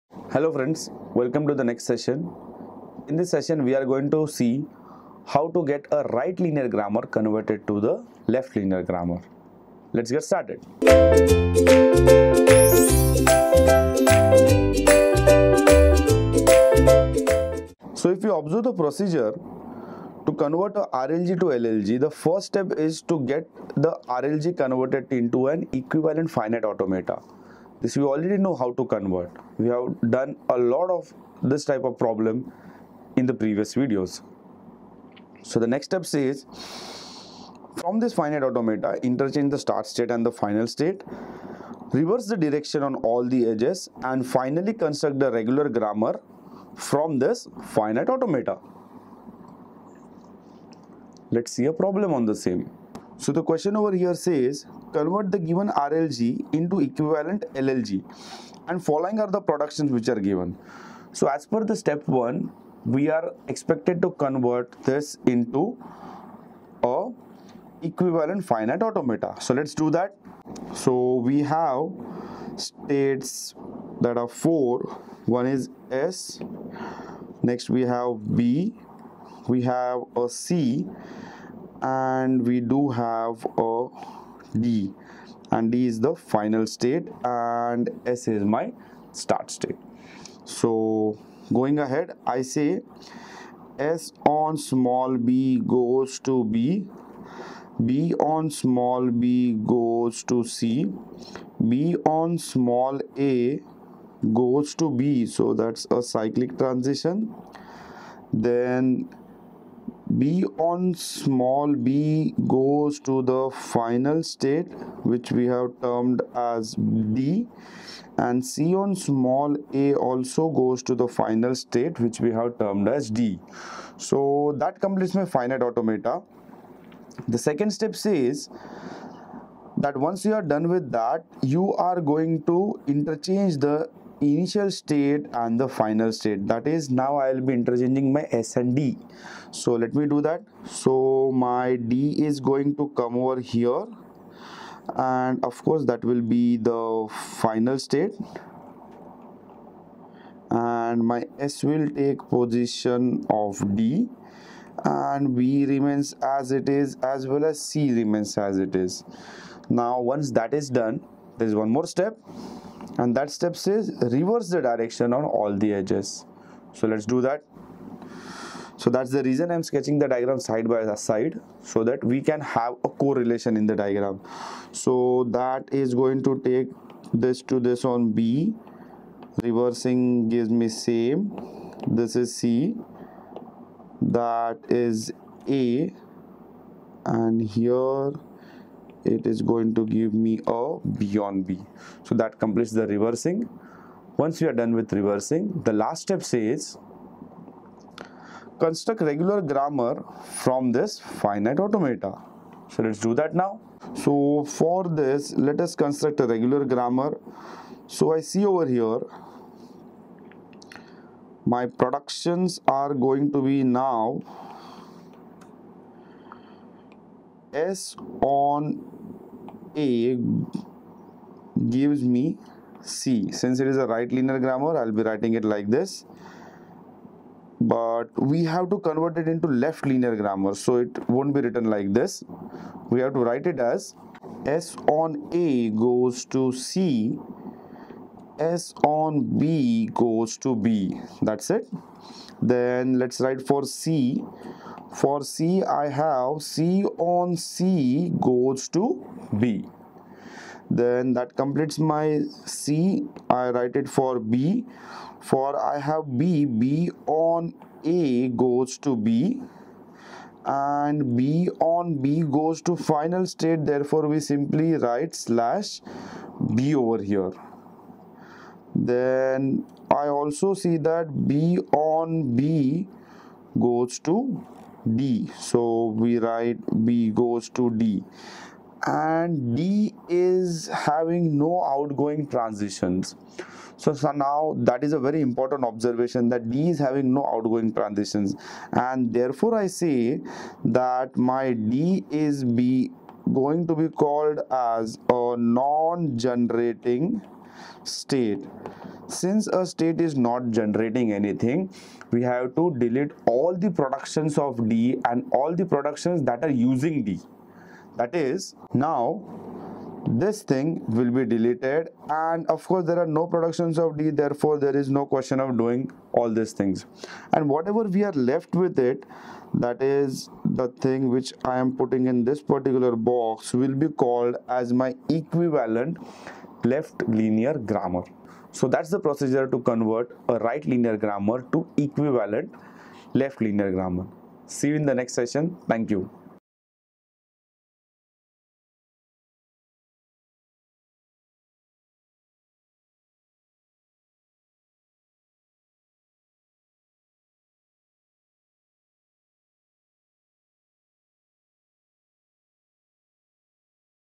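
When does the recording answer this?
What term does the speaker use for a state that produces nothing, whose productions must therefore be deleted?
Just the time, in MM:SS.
04:55.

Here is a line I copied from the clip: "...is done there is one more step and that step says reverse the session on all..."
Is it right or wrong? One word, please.
wrong.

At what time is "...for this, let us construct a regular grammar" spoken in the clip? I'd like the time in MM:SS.
03:24.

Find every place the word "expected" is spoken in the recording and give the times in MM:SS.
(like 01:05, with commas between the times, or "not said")
01:03.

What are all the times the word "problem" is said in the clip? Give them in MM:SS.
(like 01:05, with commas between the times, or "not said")
00:31, 00:51.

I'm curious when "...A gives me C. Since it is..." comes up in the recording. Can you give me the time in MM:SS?
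03:39.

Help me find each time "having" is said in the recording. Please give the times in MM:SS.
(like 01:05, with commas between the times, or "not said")
04:40, 04:46.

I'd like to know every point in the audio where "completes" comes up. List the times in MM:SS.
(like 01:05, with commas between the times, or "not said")
02:04, 03:12, 04:11.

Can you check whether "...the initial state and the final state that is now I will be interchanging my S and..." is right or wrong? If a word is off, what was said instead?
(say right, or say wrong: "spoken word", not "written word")
right.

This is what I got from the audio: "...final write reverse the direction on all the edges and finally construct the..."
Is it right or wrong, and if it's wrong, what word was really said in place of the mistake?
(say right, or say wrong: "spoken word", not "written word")
wrong: "state", not "write".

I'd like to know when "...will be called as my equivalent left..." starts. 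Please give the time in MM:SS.
05:23.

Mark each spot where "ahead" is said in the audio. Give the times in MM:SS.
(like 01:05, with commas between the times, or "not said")
01:31.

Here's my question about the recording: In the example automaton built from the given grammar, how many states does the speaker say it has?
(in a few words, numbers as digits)
4.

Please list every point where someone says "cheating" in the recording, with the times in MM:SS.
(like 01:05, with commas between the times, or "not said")
not said.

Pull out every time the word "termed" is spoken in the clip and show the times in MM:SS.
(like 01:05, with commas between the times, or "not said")
01:55, 02:02.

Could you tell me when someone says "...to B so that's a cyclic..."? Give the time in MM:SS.
01:44.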